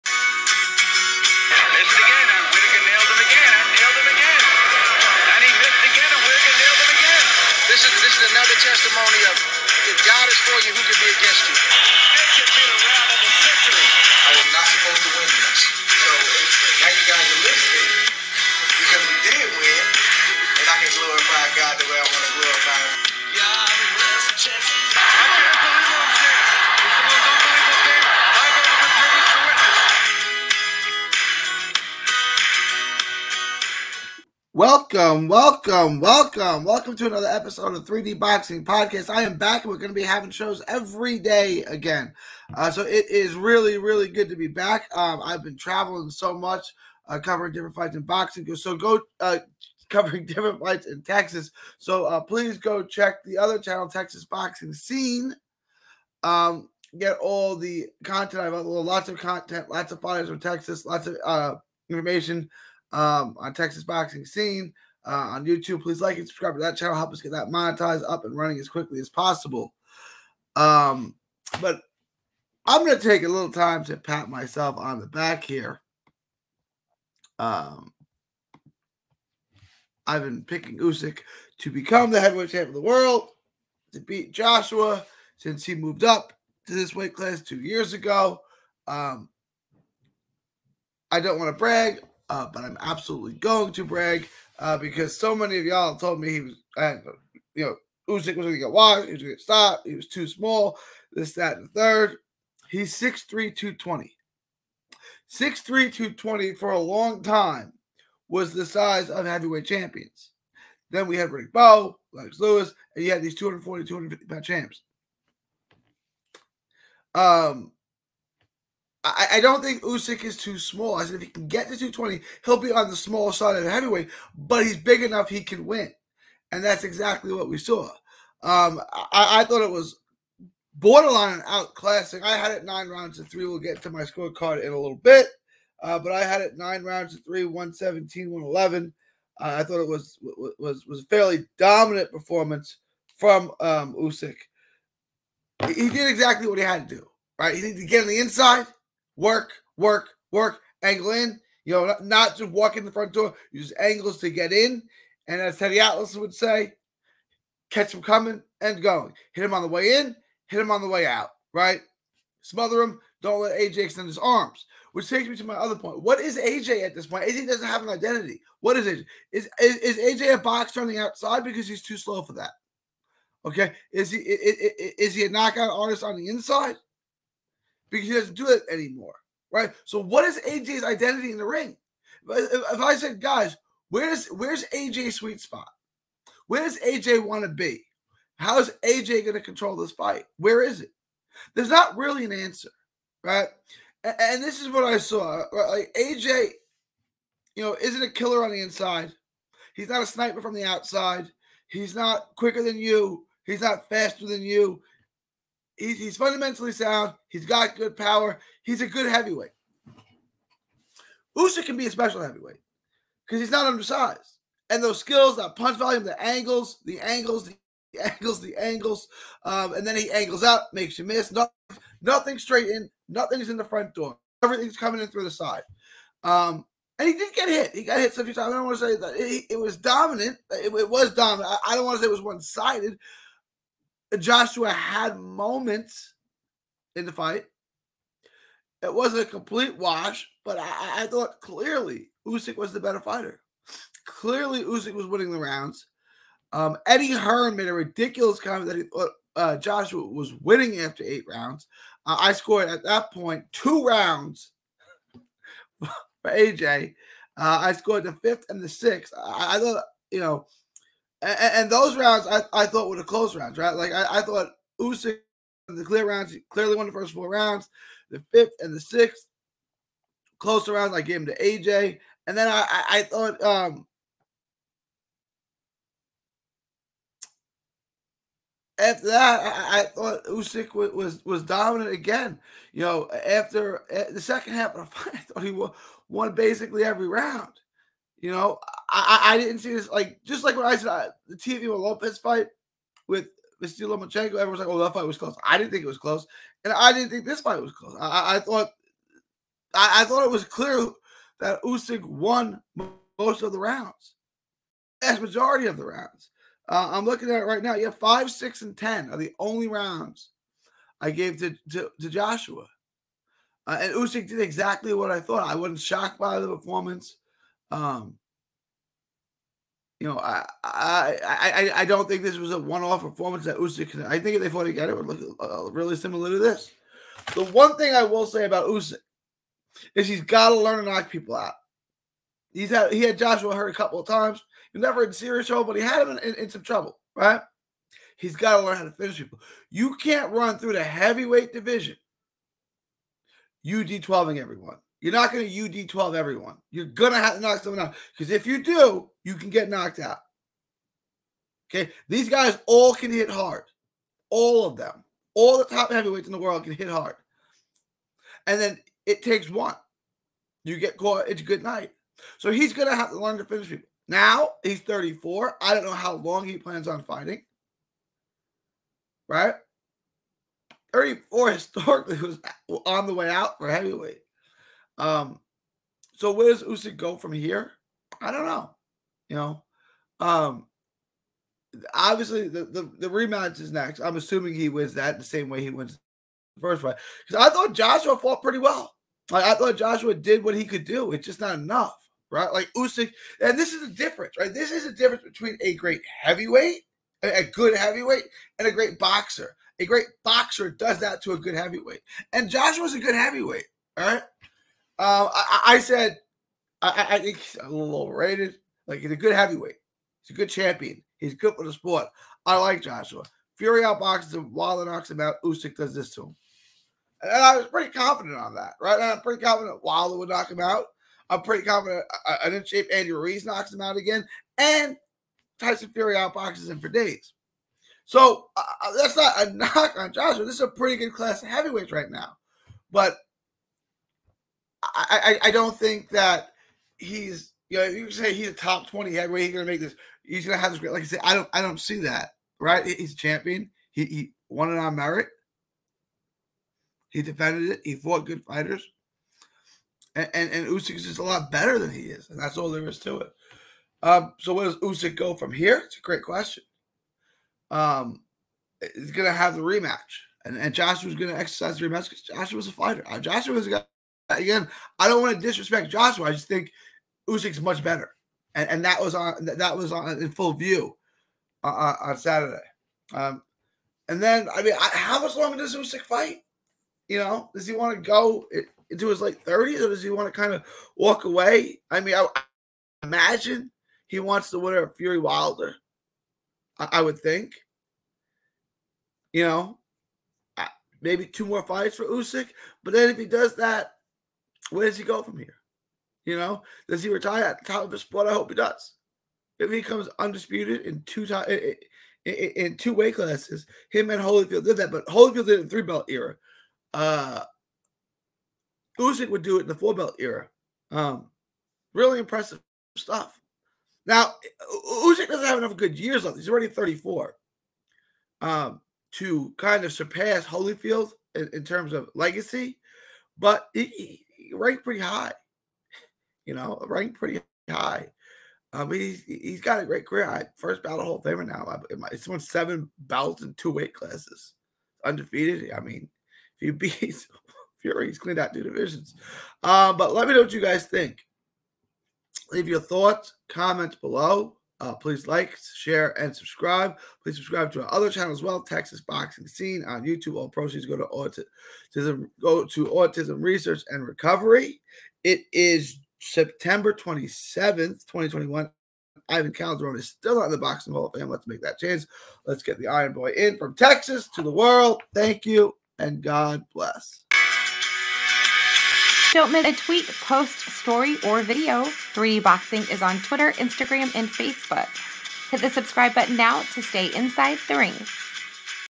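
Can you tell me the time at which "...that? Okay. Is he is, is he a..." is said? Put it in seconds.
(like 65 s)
172 s.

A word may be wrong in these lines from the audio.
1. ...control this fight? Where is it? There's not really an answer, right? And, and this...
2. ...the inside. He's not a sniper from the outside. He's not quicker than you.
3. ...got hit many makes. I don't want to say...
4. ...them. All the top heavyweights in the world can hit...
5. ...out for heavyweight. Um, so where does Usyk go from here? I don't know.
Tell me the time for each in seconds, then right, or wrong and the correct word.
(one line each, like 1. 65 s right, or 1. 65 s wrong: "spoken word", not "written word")
1. 189 s right
2. 198 s right
3. 227 s wrong: "times", not "makes"
4. 354 s right
5. 373 s right.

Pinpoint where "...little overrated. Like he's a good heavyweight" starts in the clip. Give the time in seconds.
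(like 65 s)
407 s.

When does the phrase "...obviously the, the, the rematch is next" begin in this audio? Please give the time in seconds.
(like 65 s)
381 s.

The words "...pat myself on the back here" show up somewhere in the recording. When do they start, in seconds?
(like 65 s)
73 s.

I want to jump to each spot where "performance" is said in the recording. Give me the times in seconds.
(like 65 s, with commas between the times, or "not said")
142 s, 316 s, 323 s.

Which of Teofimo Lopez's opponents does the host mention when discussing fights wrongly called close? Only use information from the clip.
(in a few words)
Vasil Lomachenko.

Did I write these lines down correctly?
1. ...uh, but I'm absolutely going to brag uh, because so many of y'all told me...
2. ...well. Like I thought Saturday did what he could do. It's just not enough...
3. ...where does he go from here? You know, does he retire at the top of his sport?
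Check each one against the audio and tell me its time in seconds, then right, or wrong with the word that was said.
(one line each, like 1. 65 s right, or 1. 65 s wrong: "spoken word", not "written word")
1. 92 s right
2. 388 s wrong: "Joshua", not "Saturday"
3. 494 s right.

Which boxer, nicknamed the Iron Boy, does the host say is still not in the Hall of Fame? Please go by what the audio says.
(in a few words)
Ivan Calderon.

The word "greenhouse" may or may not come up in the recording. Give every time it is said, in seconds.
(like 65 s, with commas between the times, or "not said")
not said.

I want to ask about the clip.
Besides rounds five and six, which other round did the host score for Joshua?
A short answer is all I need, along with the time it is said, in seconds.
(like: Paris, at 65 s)
10, at 308 s.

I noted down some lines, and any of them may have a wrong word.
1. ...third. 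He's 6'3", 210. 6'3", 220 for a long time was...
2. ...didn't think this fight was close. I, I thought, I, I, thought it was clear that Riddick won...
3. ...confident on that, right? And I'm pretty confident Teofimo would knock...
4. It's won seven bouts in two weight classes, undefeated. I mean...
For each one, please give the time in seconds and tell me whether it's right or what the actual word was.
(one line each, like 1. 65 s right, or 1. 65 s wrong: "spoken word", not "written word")
1. 101 s wrong: "220", not "210"
2. 296 s wrong: "Usyk", not "Riddick"
3. 417 s wrong: "Wilder", not "Teofimo"
4. 532 s right.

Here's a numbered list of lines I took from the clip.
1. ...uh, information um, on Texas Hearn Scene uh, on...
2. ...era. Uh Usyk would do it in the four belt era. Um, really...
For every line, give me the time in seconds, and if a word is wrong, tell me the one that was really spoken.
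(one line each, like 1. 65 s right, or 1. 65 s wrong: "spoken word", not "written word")
1. 61 s wrong: "Boxing", not "Hearn"
2. 506 s right.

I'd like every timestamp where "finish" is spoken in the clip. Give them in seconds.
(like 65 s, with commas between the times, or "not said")
338 s, 363 s.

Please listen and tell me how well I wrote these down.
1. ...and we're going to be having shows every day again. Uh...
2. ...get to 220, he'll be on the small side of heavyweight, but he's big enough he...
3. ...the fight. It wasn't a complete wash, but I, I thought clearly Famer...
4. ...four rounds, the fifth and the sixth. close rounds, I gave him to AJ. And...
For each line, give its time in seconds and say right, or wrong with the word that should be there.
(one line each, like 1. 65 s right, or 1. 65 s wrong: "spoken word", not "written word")
1. 39 s right
2. 121 s right
3. 237 s wrong: "Usyk", not "Famer"
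4. 267 s right.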